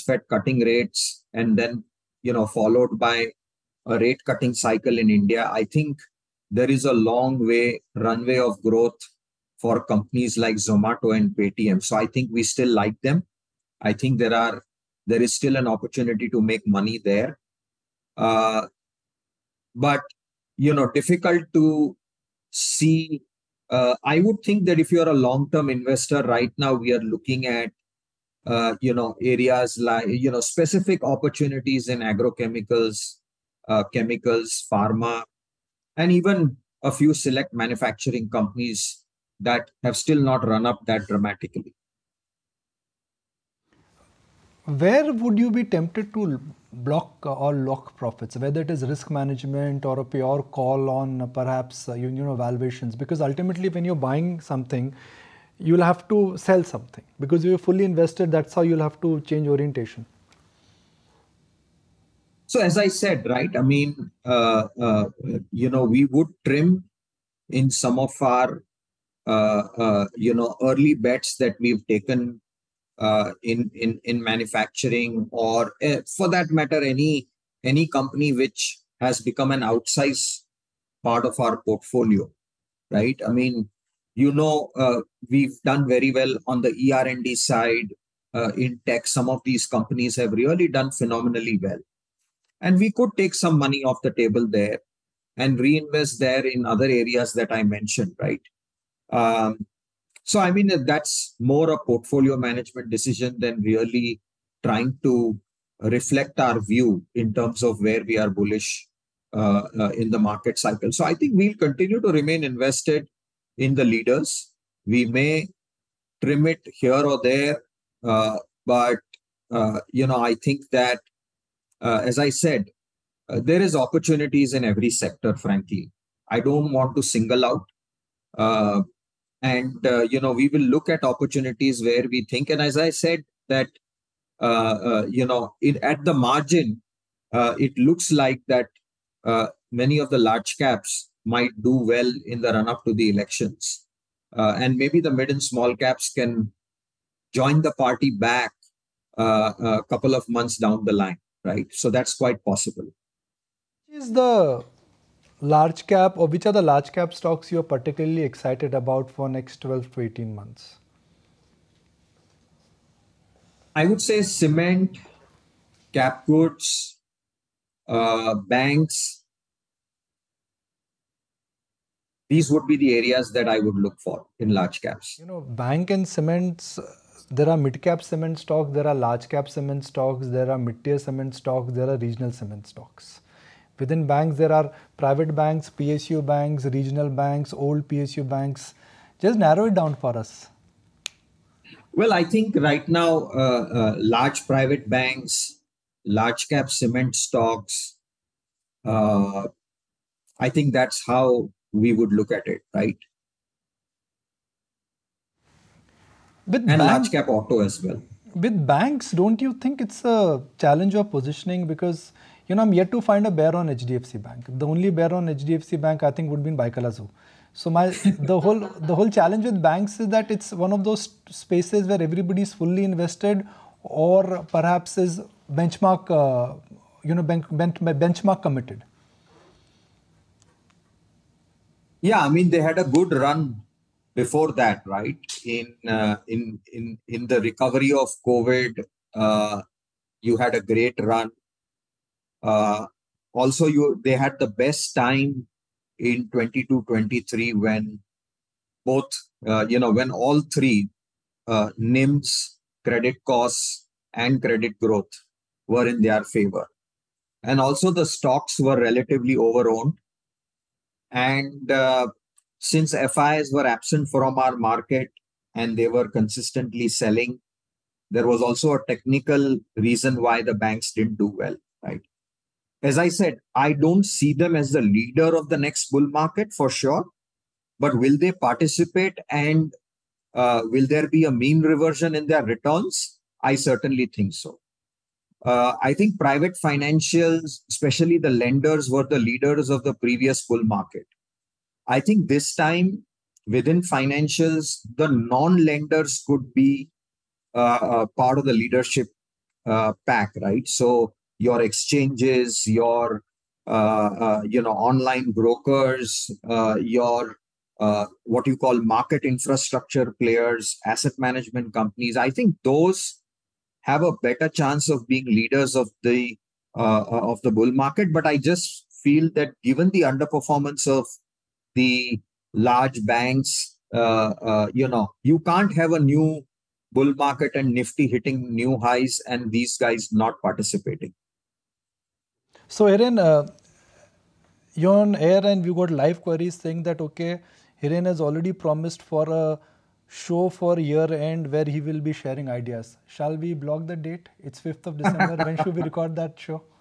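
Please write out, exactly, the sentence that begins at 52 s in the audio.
Because ultimately, when you're buying something, you'll have to sell something because you're fully invested.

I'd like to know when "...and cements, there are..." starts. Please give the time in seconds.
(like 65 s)
175 s.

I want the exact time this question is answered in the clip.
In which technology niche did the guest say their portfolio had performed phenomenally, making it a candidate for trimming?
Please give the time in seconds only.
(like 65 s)
86 s.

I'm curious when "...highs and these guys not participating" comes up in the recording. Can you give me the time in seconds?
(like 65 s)
328 s.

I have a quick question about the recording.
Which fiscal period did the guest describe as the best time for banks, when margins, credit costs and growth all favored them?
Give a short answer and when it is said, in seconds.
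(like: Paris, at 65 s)
2022-23, at 246 s.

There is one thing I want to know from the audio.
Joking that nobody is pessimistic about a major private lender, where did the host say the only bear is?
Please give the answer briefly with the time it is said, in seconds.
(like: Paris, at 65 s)
Byculla Zoo, at 216 s.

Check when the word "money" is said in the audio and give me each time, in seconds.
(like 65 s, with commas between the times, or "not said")
16 s, 93 s.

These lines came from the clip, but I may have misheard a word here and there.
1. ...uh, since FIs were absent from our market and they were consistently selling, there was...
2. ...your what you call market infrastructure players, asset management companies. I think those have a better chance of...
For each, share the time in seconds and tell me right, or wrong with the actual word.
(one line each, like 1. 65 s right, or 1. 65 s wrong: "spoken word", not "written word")
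1. 261 s right
2. 306 s right.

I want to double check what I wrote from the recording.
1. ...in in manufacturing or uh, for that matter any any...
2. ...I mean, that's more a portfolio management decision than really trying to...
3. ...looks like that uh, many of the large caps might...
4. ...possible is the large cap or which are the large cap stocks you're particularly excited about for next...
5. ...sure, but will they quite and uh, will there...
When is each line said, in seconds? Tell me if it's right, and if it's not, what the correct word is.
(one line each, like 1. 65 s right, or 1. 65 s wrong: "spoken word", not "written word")
1. 73 s right
2. 100 s right
3. 137 s right
4. 152 s right
5. 276 s wrong: "participate", not "quite".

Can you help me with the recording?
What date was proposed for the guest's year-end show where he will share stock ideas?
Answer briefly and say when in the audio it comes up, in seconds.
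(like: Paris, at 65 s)
5 December, at 344 s.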